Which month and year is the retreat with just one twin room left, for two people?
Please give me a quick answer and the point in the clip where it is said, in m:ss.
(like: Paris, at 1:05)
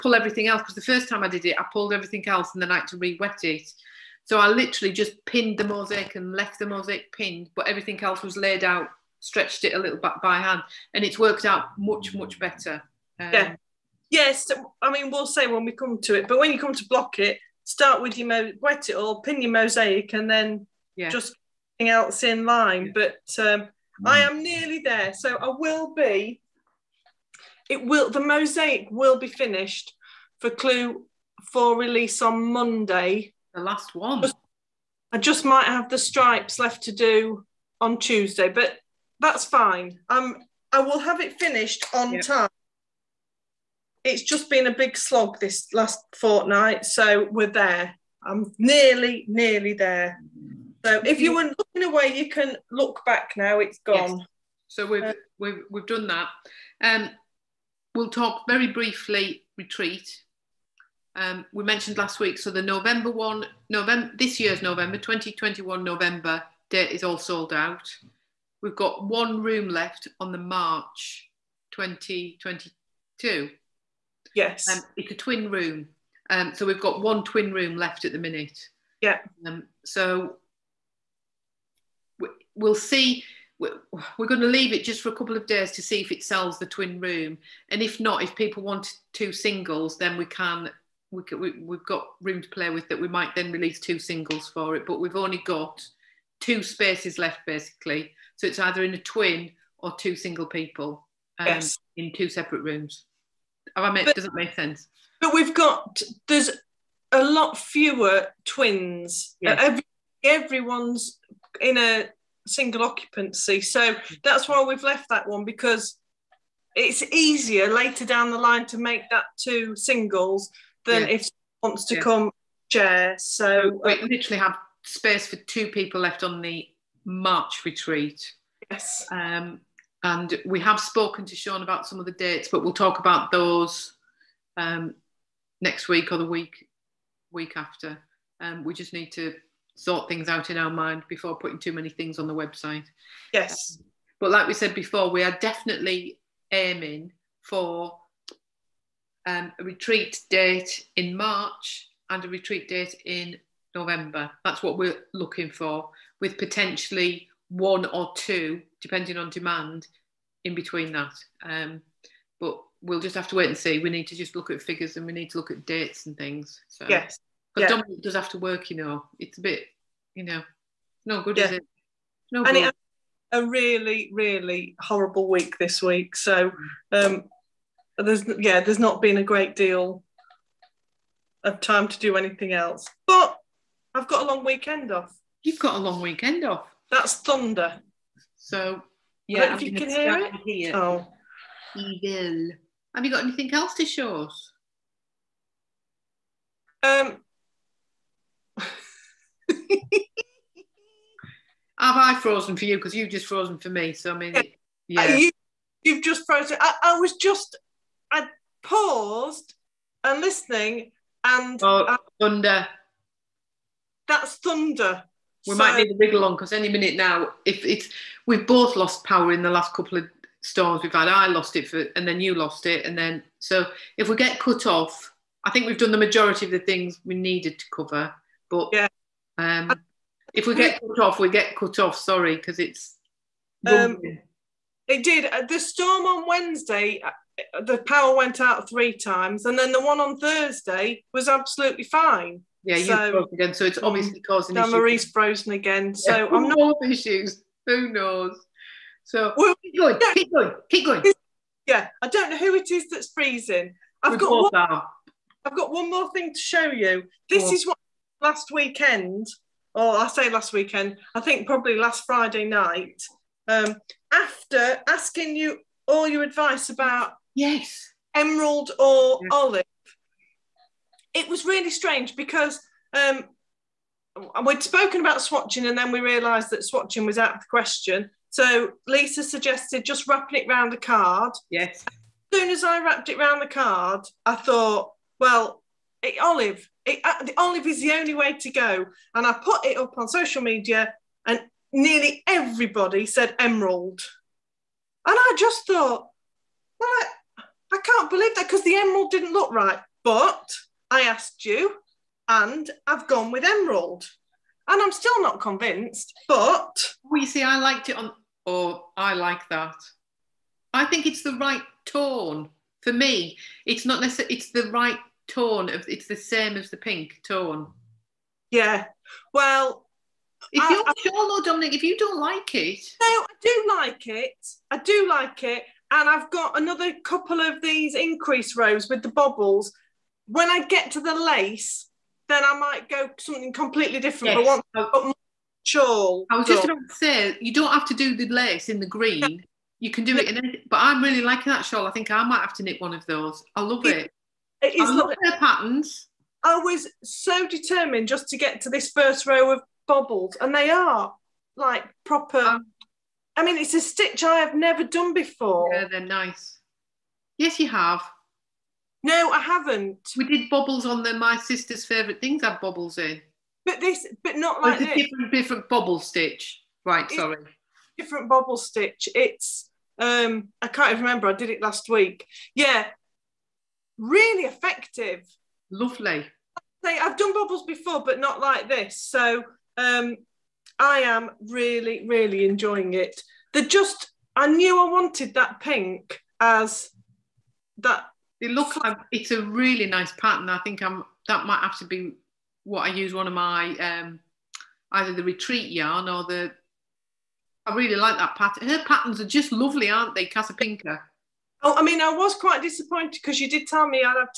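March 2022, at 1:10.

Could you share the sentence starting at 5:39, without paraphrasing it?
You can do it in But I'm really liking that shawl.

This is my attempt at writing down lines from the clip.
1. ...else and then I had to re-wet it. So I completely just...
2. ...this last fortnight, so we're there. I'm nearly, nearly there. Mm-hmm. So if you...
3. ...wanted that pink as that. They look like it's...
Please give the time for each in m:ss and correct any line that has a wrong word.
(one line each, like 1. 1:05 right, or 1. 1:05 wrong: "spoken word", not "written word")
1. 0:02 wrong: "literally", not "completely"
2. 0:45 right
3. 6:24 right.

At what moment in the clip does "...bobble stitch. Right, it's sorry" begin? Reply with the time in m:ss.
6:05.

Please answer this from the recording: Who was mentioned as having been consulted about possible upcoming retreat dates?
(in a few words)
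Sean.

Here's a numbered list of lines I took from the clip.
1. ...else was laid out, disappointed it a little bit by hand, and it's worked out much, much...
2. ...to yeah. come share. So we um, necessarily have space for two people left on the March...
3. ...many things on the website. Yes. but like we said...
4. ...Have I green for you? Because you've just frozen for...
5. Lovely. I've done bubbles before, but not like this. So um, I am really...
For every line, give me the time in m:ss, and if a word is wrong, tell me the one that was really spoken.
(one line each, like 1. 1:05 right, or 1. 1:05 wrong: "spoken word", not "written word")
1. 0:08 wrong: "stretched", not "disappointed"
2. 2:01 wrong: "literally", not "necessarily"
3. 2:21 right
4. 3:21 wrong: "frozen", not "green"
5. 6:15 right.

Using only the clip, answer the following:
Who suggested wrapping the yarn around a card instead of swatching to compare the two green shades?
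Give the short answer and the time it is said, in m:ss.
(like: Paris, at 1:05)
Lisa, at 4:38.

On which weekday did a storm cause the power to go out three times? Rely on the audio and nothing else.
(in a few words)
Wednesday.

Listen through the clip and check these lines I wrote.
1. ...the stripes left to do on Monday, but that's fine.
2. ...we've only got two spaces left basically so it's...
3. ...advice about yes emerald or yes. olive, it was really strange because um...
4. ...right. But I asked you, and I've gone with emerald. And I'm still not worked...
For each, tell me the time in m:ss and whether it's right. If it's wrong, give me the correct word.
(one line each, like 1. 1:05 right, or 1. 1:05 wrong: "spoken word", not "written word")
1. 0:35 wrong: "Tuesday", not "Monday"
2. 1:34 right
3. 4:26 right
4. 4:59 wrong: "convinced", not "worked".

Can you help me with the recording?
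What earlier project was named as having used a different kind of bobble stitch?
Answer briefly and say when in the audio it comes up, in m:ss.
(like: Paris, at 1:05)
My Sister's Favourite Things, at 6:01.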